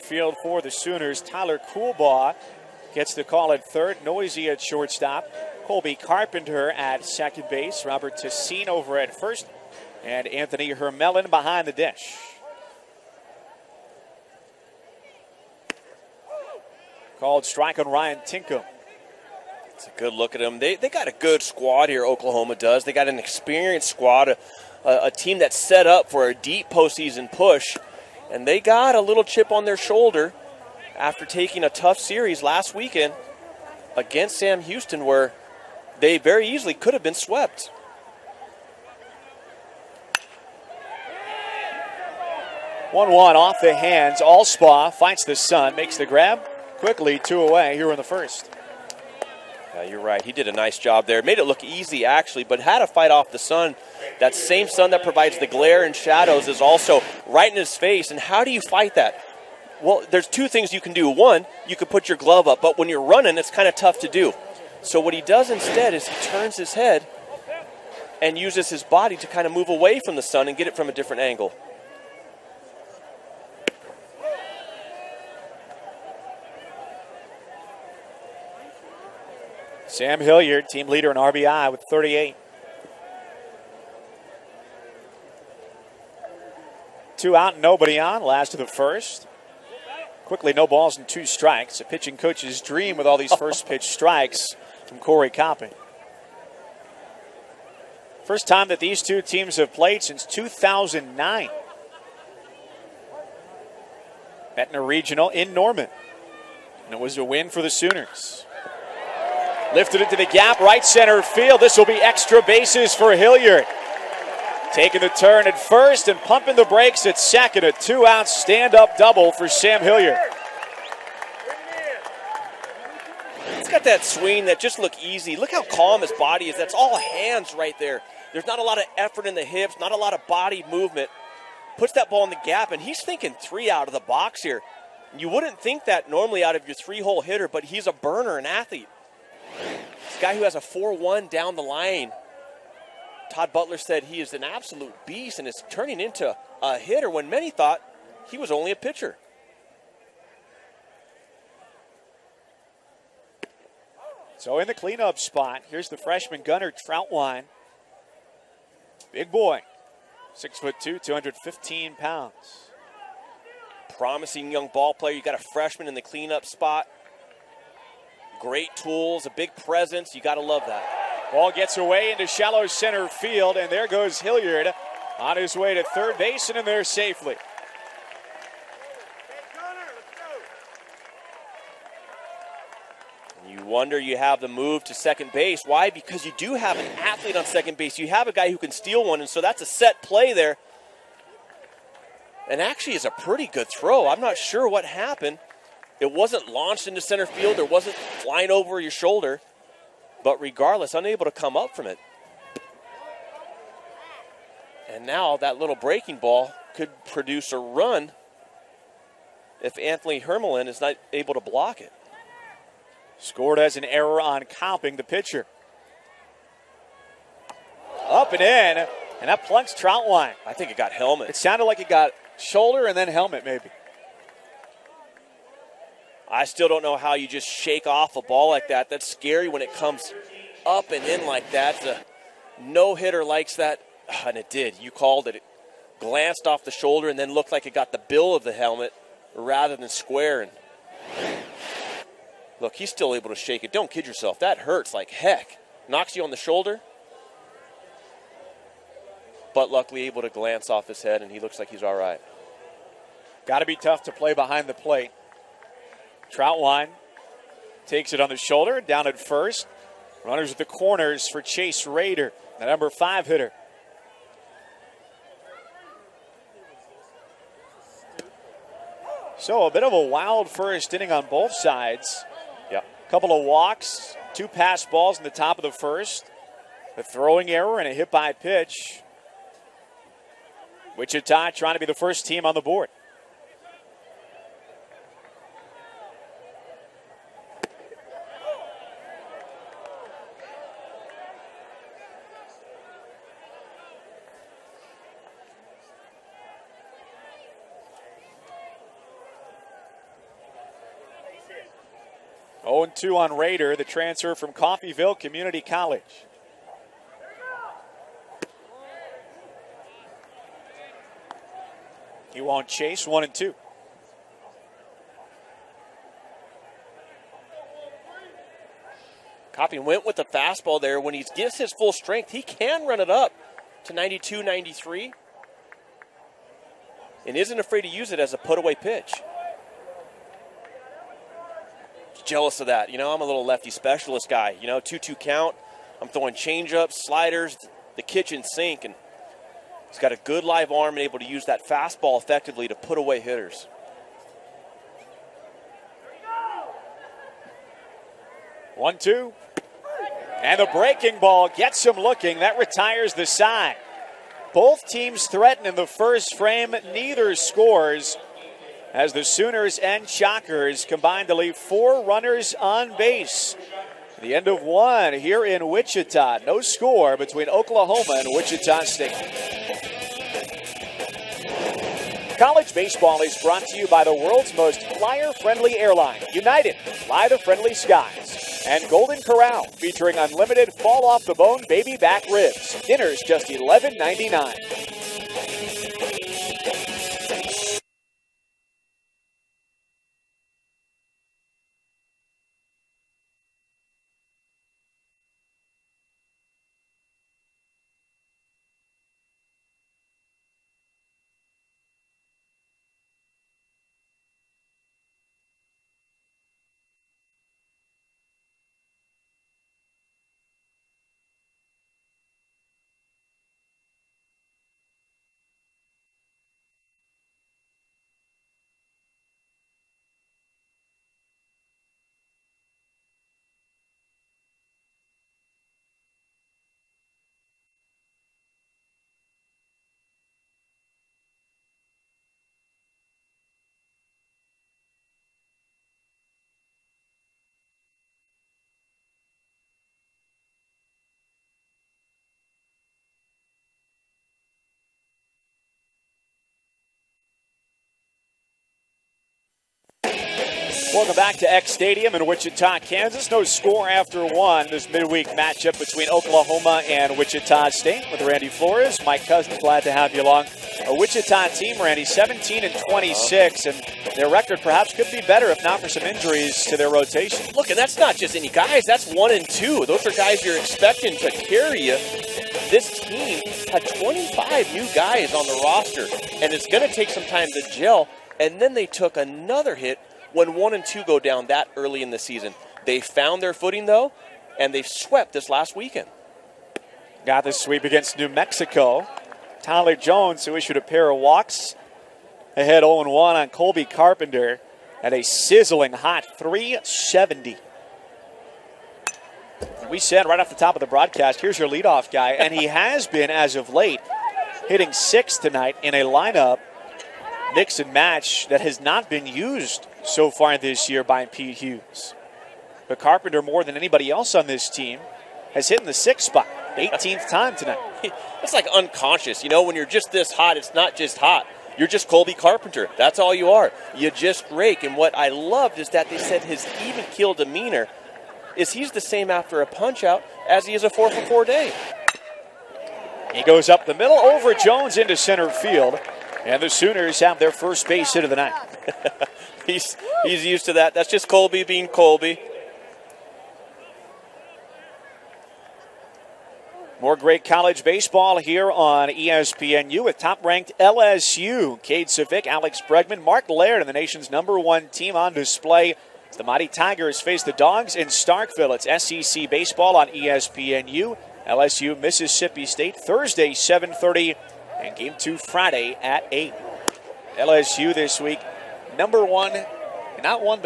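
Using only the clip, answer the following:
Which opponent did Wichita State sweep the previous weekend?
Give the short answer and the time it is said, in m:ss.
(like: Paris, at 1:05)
New Mexico, at 8:08.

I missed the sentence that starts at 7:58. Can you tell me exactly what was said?
And then they took another hit when one and two go down that early in the season.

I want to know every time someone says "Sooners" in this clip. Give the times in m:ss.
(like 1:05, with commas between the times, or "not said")
0:00, 1:47, 5:59, 8:56.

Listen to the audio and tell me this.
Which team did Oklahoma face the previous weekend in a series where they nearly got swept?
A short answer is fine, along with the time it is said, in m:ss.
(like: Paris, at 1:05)
Sam Houston, at 0:34.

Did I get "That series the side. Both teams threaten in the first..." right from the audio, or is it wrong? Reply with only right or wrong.
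wrong.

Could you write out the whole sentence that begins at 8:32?
But Carpenter, more than anybody else on this team, has hit in the sixth spot, 18th time tonight.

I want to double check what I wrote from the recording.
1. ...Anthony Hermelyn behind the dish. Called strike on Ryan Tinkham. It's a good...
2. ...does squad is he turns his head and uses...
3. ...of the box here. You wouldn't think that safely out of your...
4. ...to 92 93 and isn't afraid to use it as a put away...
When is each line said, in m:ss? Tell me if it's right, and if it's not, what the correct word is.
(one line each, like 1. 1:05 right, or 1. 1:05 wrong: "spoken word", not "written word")
1. 0:10 right
2. 1:05 wrong: "instead", not "squad"
3. 2:13 wrong: "normally", not "safely"
4. 5:23 right.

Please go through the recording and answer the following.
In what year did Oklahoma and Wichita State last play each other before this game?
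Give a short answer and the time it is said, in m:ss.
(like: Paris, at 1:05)
2009, at 1:40.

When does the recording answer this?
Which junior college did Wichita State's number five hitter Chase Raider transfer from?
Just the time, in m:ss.
5:04.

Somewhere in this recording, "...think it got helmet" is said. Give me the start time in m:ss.
3:40.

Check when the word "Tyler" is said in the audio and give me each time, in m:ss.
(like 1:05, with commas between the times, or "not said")
0:01, 8:09.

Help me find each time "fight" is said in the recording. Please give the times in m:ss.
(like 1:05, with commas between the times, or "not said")
0:44, 0:52, 0:58.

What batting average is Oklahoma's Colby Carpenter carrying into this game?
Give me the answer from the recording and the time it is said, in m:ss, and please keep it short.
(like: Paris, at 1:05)
370, at 8:16.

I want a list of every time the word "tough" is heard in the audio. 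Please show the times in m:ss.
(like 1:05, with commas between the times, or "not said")
0:31, 1:03, 4:13.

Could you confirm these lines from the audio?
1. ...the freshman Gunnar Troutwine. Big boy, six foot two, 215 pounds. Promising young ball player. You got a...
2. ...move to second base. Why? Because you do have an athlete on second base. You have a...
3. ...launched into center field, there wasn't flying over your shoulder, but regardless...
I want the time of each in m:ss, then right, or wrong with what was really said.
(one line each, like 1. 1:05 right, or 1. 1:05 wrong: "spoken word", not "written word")
1. 2:35 right
2. 3:04 right
3. 3:16 right.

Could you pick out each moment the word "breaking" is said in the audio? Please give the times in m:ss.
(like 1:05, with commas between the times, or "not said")
3:25, 5:50.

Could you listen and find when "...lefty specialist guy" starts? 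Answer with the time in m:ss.
5:33.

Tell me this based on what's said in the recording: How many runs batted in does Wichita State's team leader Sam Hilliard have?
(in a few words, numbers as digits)
38.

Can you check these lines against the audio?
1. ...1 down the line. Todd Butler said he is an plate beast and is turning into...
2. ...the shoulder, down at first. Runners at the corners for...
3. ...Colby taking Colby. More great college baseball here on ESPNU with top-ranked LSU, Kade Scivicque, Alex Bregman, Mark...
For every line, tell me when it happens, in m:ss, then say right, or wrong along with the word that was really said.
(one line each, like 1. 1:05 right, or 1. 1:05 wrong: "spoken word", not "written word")
1. 2:20 wrong: "absolute", not "plate"
2. 4:18 right
3. 9:01 wrong: "being", not "taking".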